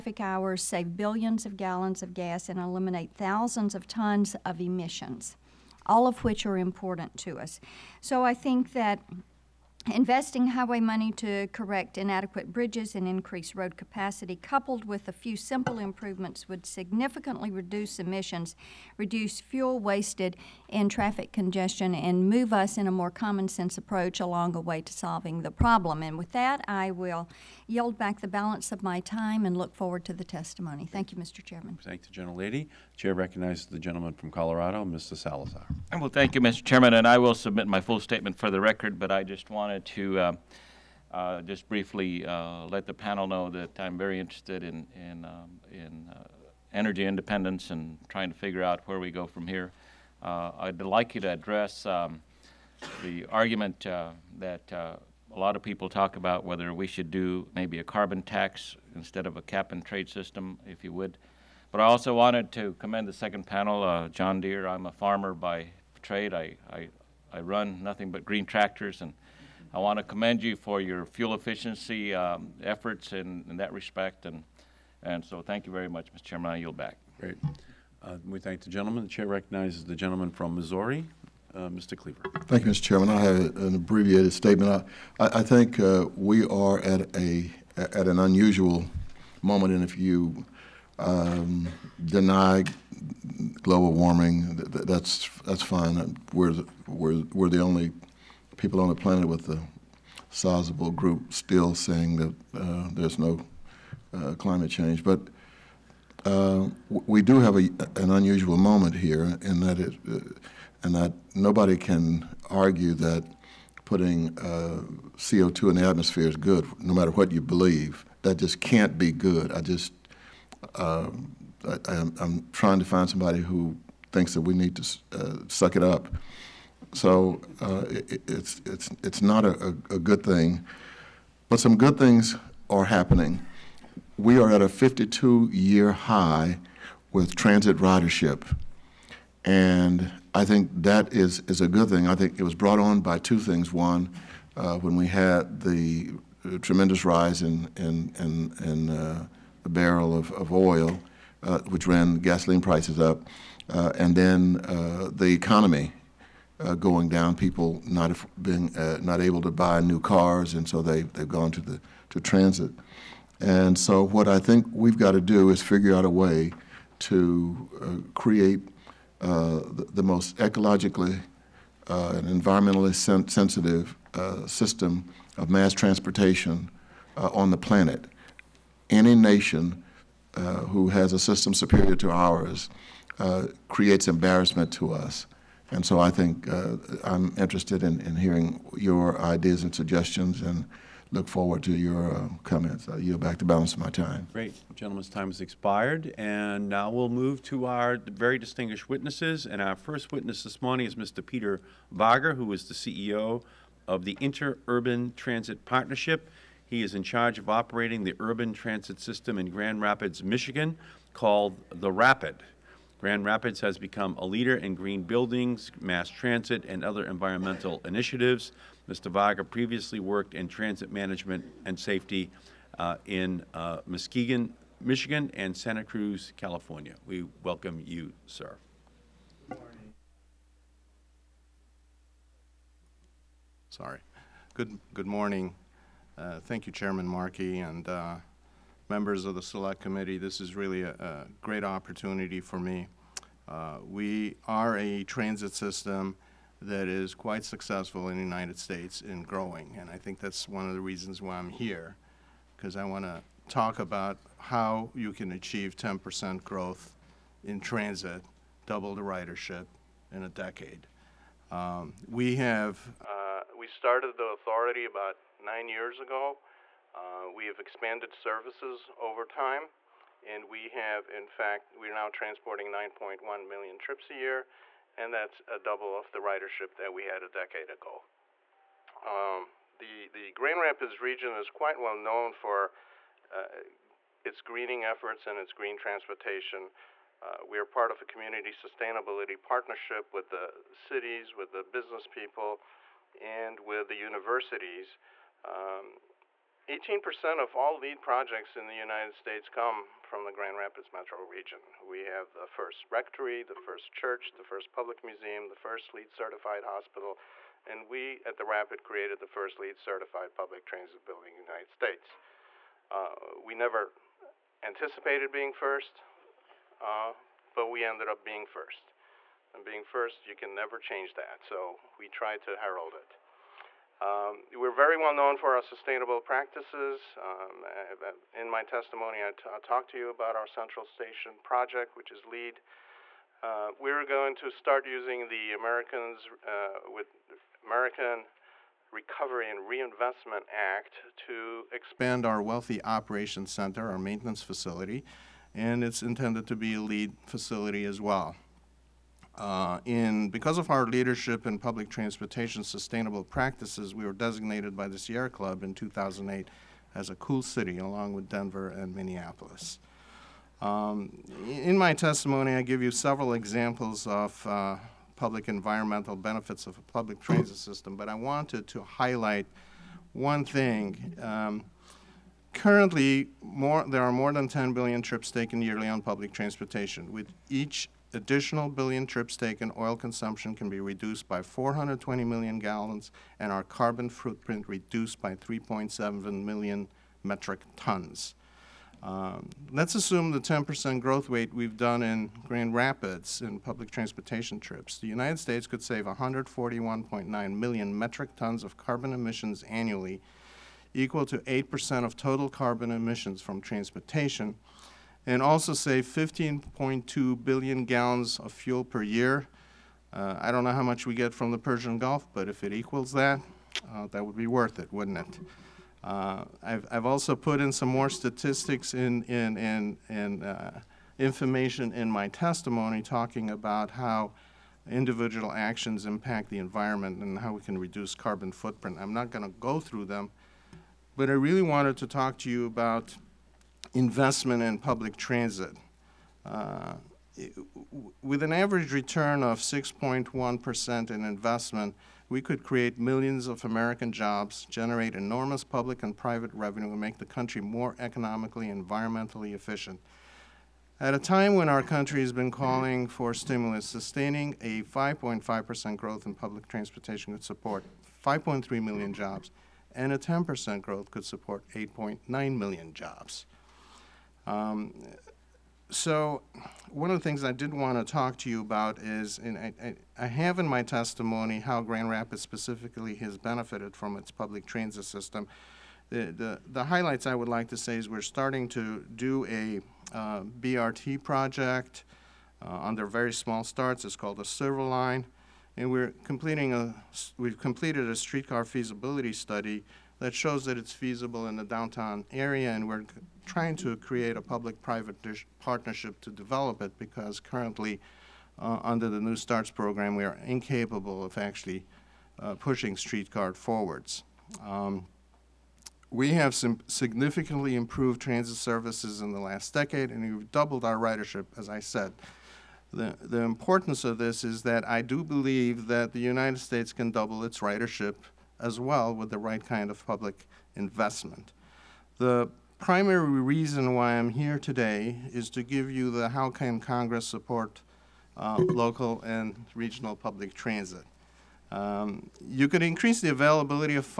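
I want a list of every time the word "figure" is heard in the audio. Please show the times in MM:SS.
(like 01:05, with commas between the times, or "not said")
00:48, 02:45.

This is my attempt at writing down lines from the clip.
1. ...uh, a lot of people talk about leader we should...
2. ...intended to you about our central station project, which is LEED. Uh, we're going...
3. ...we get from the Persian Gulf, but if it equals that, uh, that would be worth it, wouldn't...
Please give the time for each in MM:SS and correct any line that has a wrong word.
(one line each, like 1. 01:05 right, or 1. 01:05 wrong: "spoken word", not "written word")
1. 00:54 wrong: "whether", not "leader"
2. 05:29 wrong: "talked", not "intended"
3. 06:51 right.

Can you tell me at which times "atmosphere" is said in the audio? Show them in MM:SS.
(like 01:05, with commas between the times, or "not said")
01:55.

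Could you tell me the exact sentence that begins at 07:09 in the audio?
I'm not going to go through them, but I really wanted to talk to you about investment in public transit.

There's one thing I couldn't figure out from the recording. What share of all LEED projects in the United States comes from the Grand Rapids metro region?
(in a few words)
18%.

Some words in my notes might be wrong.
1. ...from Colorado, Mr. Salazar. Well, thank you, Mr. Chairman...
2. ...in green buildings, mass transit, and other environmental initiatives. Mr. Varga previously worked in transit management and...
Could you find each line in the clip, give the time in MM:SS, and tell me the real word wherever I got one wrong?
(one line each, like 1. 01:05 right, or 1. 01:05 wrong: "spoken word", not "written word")
1. 00:34 right
2. 03:34 right.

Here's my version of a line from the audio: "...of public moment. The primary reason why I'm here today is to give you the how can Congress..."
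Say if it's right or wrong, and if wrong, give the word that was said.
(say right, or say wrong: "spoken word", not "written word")
wrong: "investment", not "moment".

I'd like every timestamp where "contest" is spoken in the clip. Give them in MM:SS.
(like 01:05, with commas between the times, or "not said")
not said.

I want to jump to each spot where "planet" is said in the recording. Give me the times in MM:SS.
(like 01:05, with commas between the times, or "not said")
01:38, 02:57.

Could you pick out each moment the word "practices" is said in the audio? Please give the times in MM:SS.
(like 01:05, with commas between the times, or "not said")
05:26, 05:53.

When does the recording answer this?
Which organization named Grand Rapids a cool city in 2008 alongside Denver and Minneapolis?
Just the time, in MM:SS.
05:54.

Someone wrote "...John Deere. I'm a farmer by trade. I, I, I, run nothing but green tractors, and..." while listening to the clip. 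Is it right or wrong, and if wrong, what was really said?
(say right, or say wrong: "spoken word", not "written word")
right.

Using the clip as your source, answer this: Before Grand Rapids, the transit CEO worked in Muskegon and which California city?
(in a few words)
Santa Cruz.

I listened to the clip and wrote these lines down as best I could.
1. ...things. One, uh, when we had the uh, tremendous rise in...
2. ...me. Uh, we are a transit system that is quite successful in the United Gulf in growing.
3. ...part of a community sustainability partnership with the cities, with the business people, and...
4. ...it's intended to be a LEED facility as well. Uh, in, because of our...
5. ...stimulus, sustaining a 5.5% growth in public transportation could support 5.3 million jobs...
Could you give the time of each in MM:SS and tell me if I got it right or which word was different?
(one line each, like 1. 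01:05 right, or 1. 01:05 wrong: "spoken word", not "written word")
1. 02:23 right
2. 04:02 wrong: "States", not "Gulf"
3. 04:47 right
4. 05:45 right
5. 07:33 right.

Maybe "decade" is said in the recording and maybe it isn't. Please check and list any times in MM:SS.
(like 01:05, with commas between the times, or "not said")
04:20, 04:37, 08:29.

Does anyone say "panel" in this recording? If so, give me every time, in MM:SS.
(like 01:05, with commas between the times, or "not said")
00:42, 01:03.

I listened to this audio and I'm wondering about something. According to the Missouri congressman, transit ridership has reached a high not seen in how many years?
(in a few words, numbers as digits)
52.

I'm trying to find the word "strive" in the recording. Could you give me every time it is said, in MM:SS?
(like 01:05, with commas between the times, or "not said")
not said.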